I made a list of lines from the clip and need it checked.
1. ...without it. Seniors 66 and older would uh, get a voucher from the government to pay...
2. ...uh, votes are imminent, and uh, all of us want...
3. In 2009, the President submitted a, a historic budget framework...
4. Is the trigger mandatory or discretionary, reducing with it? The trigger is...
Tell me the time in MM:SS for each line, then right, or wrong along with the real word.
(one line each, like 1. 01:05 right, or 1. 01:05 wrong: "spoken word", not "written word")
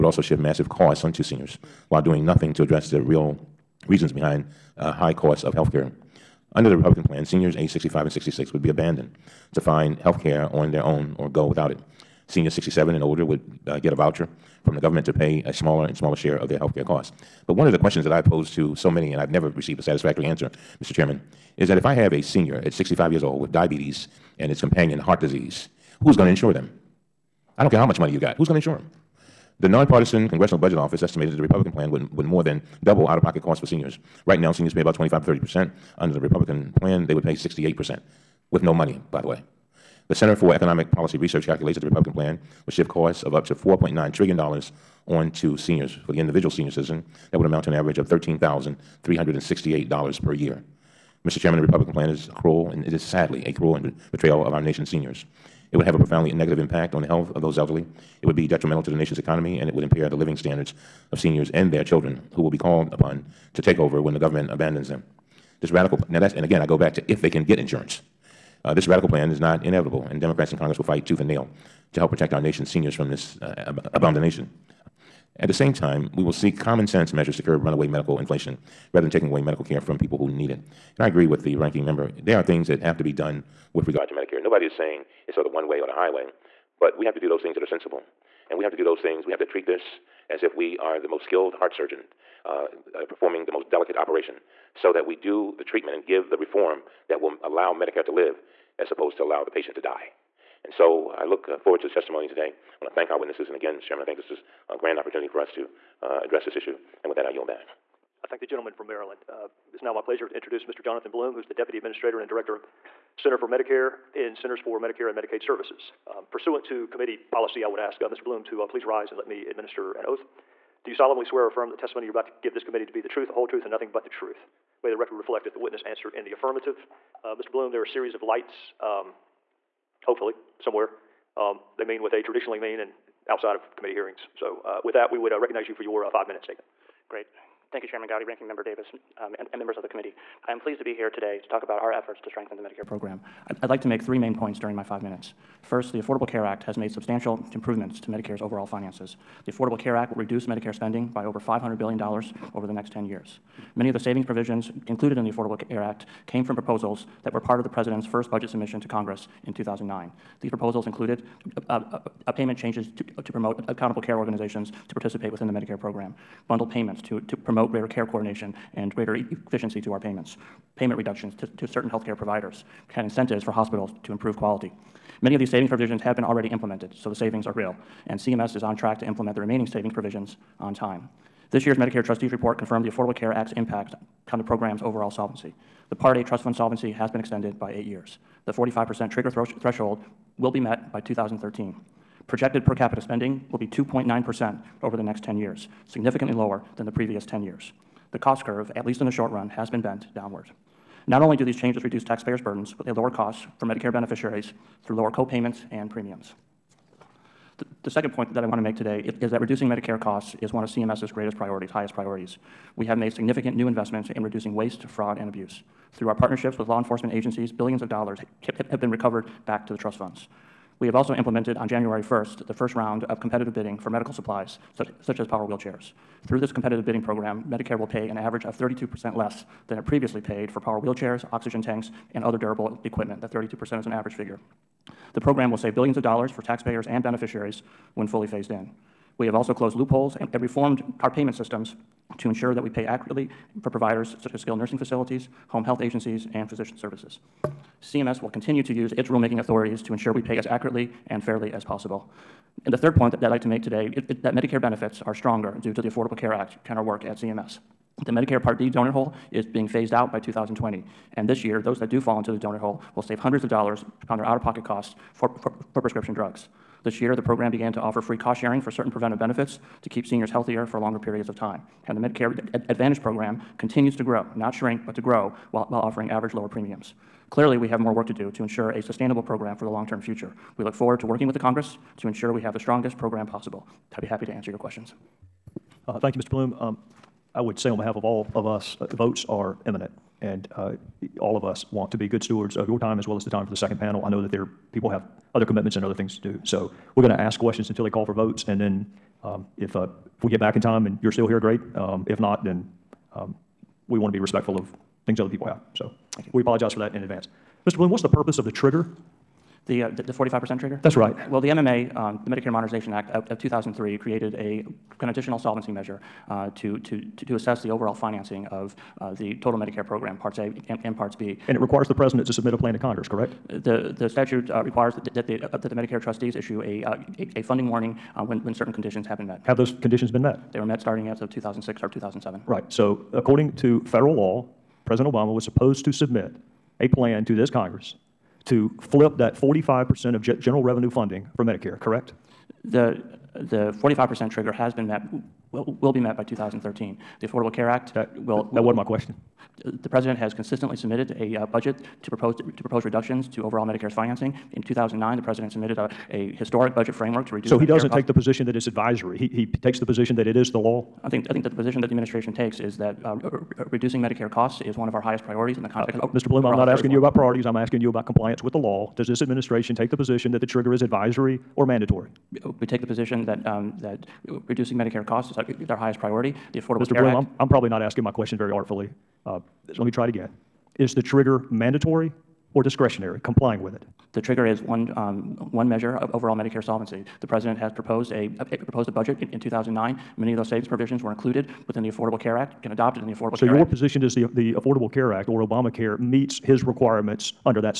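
1. 00:11 wrong: "67", not "66"
2. 04:48 right
3. 05:54 right
4. 06:20 wrong: "complying", not "reducing".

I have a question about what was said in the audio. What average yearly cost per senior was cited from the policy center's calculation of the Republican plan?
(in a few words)
$13,368.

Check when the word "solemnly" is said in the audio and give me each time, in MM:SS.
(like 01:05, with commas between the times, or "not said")
02:00.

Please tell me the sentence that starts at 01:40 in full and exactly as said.
And so uh, I look forward to the testimony today.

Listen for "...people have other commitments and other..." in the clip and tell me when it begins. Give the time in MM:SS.
04:54.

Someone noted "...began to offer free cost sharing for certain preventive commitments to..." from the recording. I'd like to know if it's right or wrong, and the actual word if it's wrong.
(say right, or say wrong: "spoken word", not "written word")
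wrong: "benefits", not "commitments".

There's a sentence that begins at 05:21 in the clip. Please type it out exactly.
And it requires the President to submit a plan to Congress, correct?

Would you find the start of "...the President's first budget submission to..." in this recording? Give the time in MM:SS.
02:37.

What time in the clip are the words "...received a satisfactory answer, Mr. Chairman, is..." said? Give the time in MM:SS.
00:19.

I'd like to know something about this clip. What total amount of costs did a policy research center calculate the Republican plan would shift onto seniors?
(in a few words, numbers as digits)
$4.9 trillion.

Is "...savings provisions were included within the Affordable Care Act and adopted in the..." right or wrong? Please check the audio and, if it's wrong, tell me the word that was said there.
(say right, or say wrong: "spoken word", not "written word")
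right.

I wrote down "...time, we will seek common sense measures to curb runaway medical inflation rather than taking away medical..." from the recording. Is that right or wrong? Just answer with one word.
right.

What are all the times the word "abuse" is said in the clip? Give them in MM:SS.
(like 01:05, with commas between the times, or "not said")
03:35.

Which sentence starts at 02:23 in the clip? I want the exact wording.
I'd, I'd like to make three main points during my five minutes.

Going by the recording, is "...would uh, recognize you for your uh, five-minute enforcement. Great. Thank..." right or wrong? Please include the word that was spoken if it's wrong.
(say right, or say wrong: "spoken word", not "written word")
wrong: "statement", not "enforcement".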